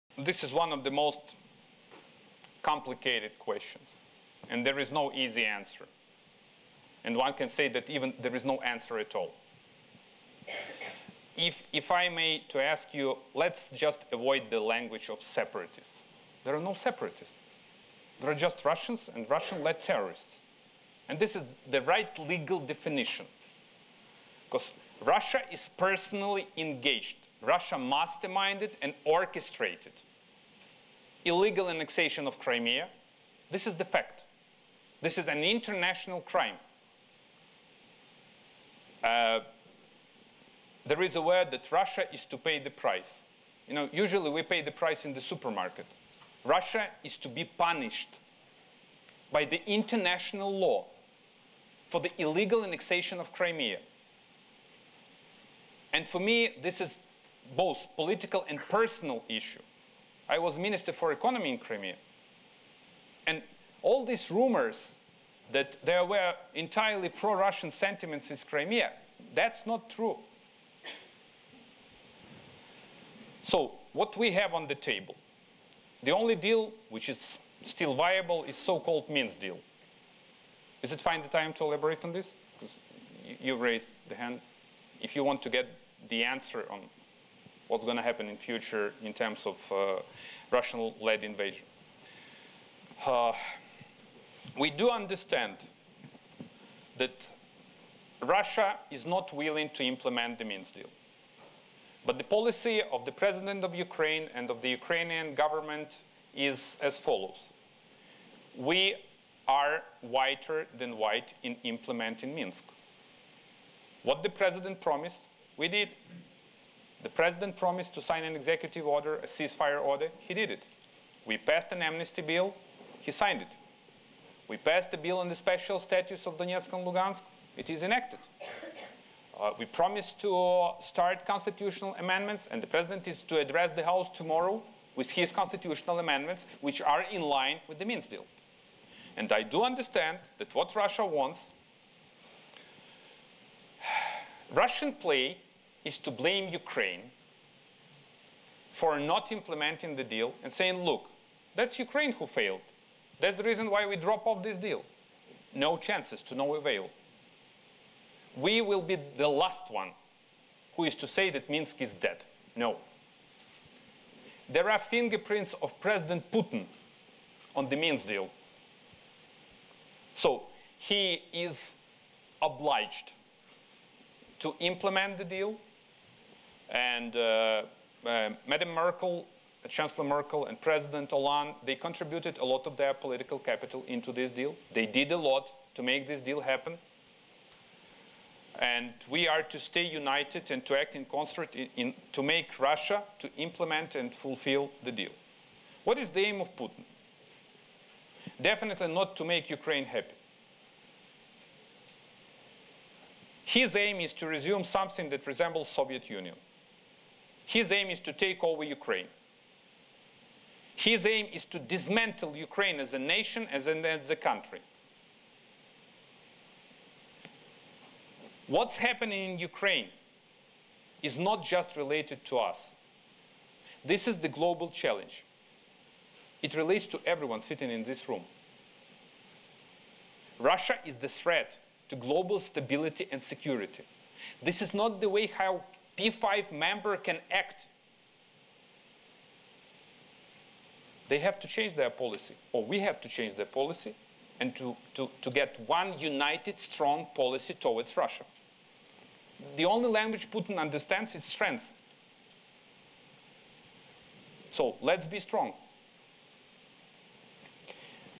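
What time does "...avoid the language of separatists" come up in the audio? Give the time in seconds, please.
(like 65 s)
14 s.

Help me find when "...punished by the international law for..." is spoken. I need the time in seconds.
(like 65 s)
47 s.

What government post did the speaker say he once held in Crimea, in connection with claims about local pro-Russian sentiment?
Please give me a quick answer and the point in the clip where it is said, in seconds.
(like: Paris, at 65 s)
Minister for Economy, at 60 s.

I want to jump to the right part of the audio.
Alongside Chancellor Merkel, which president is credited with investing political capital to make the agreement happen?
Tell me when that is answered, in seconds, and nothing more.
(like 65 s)
180 s.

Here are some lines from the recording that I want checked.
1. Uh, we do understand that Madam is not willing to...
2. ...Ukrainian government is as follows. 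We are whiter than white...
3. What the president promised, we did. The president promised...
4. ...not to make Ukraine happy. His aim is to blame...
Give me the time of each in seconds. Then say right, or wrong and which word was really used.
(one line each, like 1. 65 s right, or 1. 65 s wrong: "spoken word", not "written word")
1. 93 s wrong: "Russia", not "Madam"
2. 104 s right
3. 114 s right
4. 198 s wrong: "resume", not "blame".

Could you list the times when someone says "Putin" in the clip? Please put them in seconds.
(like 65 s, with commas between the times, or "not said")
166 s, 196 s, 250 s.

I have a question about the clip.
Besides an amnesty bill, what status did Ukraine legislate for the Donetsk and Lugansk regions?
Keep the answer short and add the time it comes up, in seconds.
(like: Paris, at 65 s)
special status, at 125 s.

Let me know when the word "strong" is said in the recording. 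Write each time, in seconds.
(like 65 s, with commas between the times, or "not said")
246 s, 255 s.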